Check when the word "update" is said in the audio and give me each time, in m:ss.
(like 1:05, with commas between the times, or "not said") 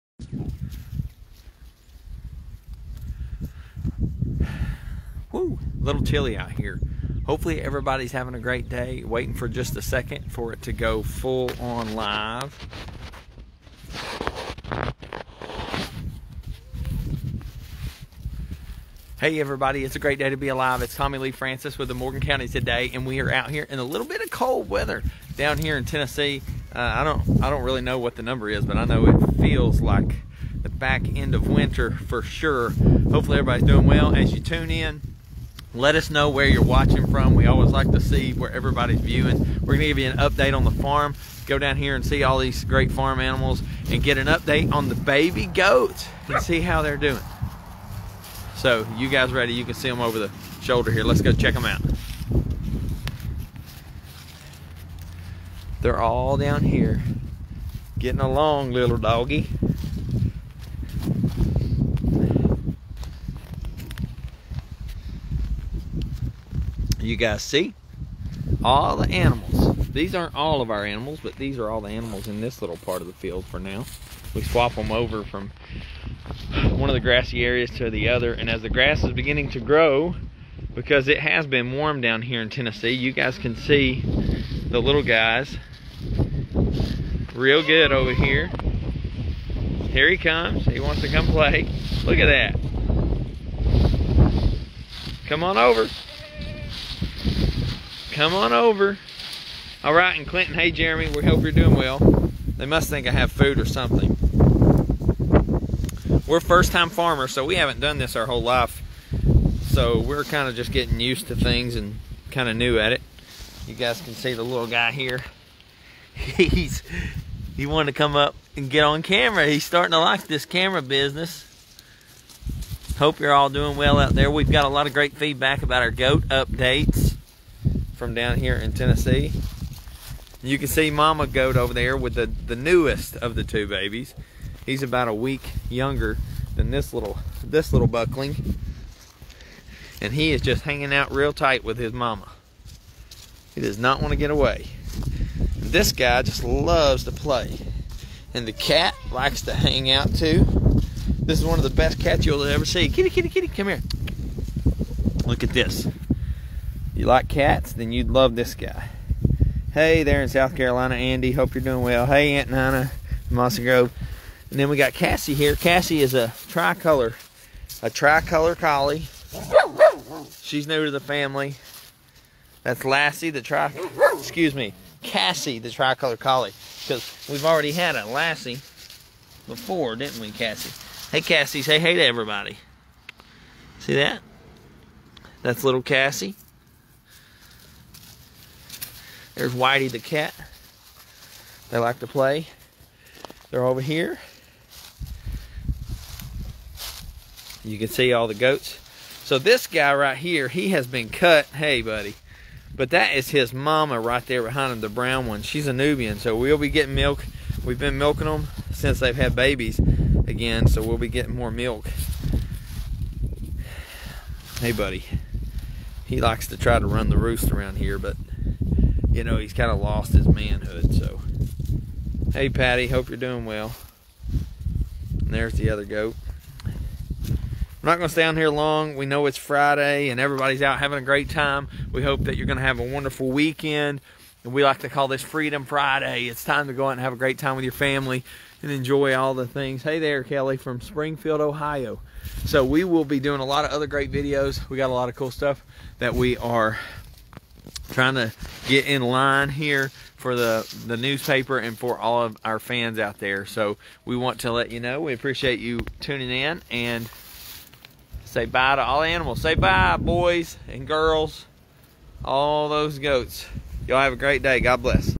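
0:40, 0:44, 2:06.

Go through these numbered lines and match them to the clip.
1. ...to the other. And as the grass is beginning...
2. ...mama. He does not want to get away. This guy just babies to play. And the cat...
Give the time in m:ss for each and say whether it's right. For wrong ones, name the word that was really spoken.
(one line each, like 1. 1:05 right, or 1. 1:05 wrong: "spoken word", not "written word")
1. 1:17 right
2. 2:21 wrong: "loves", not "babies".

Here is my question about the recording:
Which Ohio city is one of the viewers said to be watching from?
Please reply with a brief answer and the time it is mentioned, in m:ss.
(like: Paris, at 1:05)
Springfield, at 4:00.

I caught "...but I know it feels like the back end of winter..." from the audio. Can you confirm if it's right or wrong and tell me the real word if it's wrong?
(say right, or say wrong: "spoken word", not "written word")
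right.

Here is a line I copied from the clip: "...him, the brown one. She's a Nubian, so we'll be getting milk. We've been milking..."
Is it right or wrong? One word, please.
right.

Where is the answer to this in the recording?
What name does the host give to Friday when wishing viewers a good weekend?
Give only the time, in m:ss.
3:55.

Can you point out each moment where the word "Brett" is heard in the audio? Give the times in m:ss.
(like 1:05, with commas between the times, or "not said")
not said.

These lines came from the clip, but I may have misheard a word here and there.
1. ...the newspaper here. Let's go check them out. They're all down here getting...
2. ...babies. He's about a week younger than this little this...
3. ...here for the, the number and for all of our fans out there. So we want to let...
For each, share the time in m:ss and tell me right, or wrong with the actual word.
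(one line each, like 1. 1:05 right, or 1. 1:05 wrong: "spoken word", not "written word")
1. 0:50 wrong: "shoulder", not "newspaper"
2. 2:13 right
3. 4:09 wrong: "newspaper", not "number".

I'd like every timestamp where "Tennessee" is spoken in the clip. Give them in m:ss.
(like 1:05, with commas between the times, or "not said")
0:25, 1:22, 2:08.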